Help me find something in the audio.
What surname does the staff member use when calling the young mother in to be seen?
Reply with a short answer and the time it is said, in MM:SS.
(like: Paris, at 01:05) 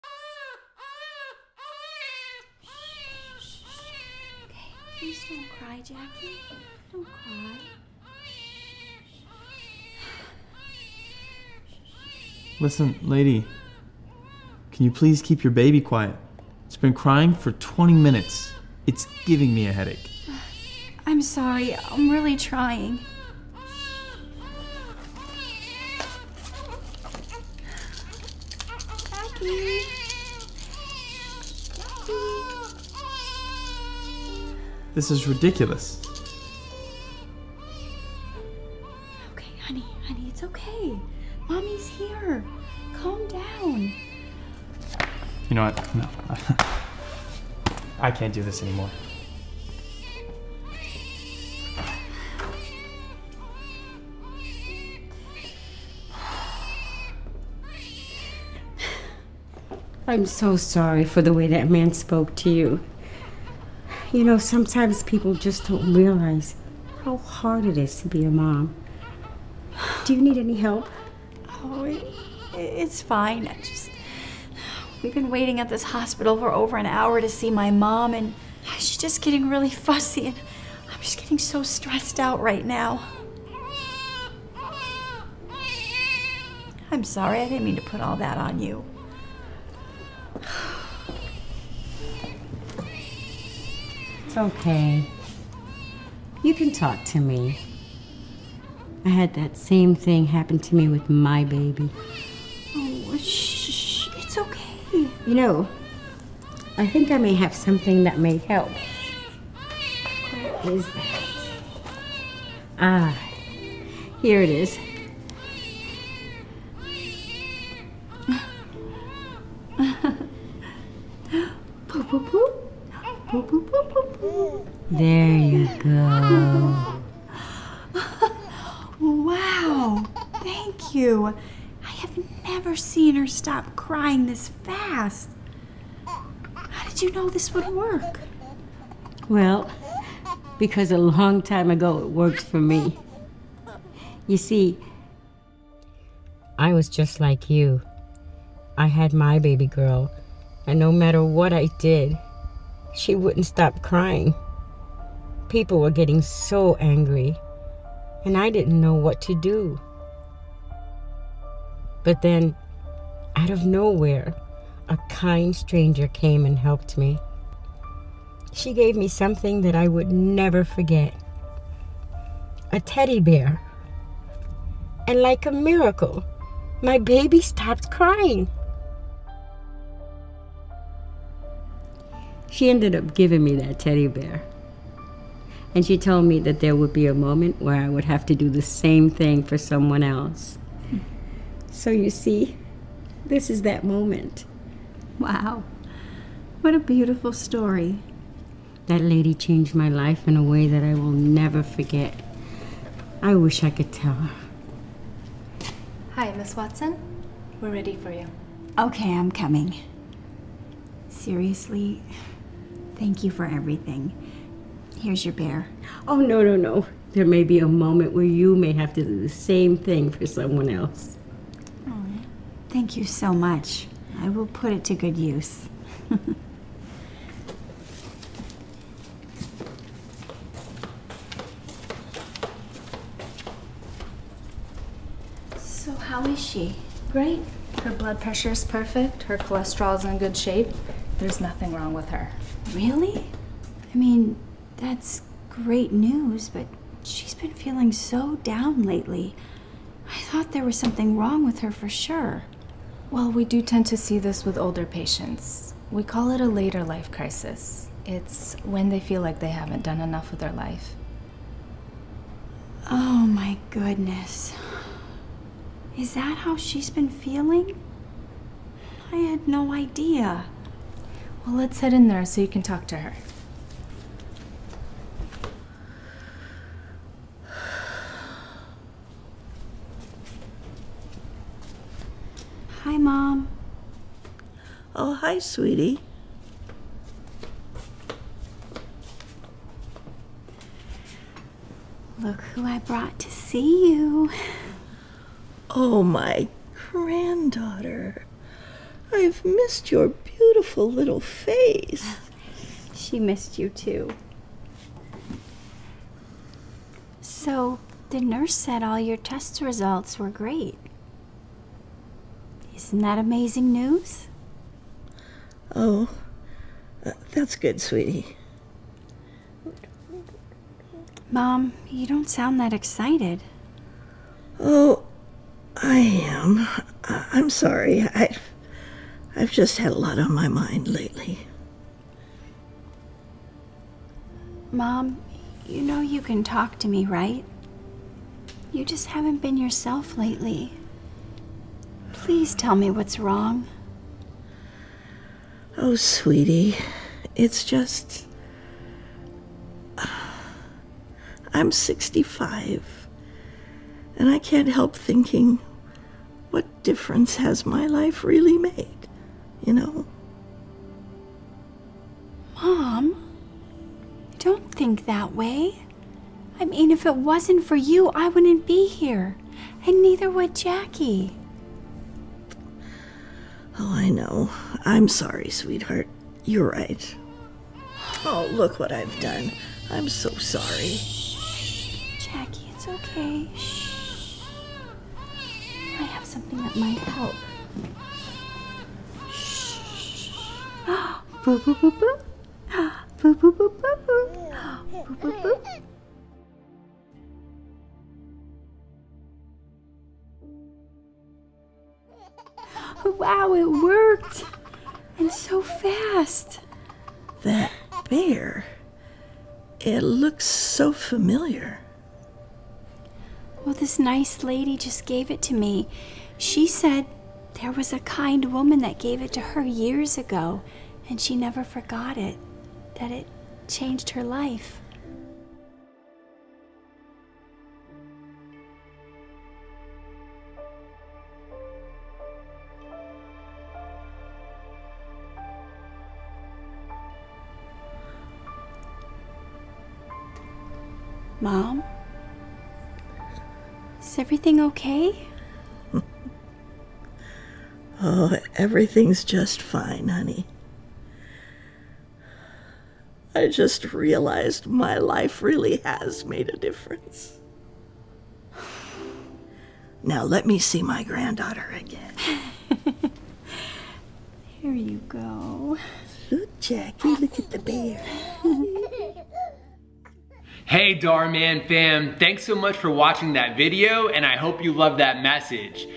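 Watson, at 03:26.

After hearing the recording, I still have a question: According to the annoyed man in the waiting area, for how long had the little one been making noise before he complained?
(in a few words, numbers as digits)
20 minutes.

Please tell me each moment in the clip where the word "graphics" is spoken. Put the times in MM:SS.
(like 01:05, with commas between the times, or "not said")
not said.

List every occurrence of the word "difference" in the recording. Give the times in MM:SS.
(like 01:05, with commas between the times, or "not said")
05:56, 07:36.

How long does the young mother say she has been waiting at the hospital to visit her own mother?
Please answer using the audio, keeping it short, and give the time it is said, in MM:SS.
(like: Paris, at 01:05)
Over an hour, at 01:16.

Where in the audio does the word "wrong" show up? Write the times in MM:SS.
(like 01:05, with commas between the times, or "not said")
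04:01, 04:11, 05:43.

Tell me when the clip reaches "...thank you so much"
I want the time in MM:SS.
03:42.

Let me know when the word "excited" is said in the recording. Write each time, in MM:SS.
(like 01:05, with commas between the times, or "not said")
05:22.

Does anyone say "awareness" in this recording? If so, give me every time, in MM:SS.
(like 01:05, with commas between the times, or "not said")
not said.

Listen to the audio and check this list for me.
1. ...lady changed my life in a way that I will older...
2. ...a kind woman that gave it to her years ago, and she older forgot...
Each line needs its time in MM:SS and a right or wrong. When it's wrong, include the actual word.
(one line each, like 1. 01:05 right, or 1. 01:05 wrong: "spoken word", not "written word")
1. 03:18 wrong: "never", not "older"
2. 06:57 wrong: "never", not "older".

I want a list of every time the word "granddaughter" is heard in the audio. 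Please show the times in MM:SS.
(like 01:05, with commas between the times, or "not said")
04:56, 07:41.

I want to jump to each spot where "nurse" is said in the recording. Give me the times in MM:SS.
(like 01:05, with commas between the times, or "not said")
05:08.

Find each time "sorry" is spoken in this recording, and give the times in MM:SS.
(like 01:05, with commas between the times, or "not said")
00:21, 01:00, 01:27, 05:27, 06:15, 06:20.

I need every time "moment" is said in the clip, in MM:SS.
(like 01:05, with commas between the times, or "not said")
03:07, 03:13, 03:37.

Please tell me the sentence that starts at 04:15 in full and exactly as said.
We call it a later life crisis.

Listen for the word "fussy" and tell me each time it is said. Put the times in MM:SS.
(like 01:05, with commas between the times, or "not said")
01:19.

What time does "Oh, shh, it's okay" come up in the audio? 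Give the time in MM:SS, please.
01:42.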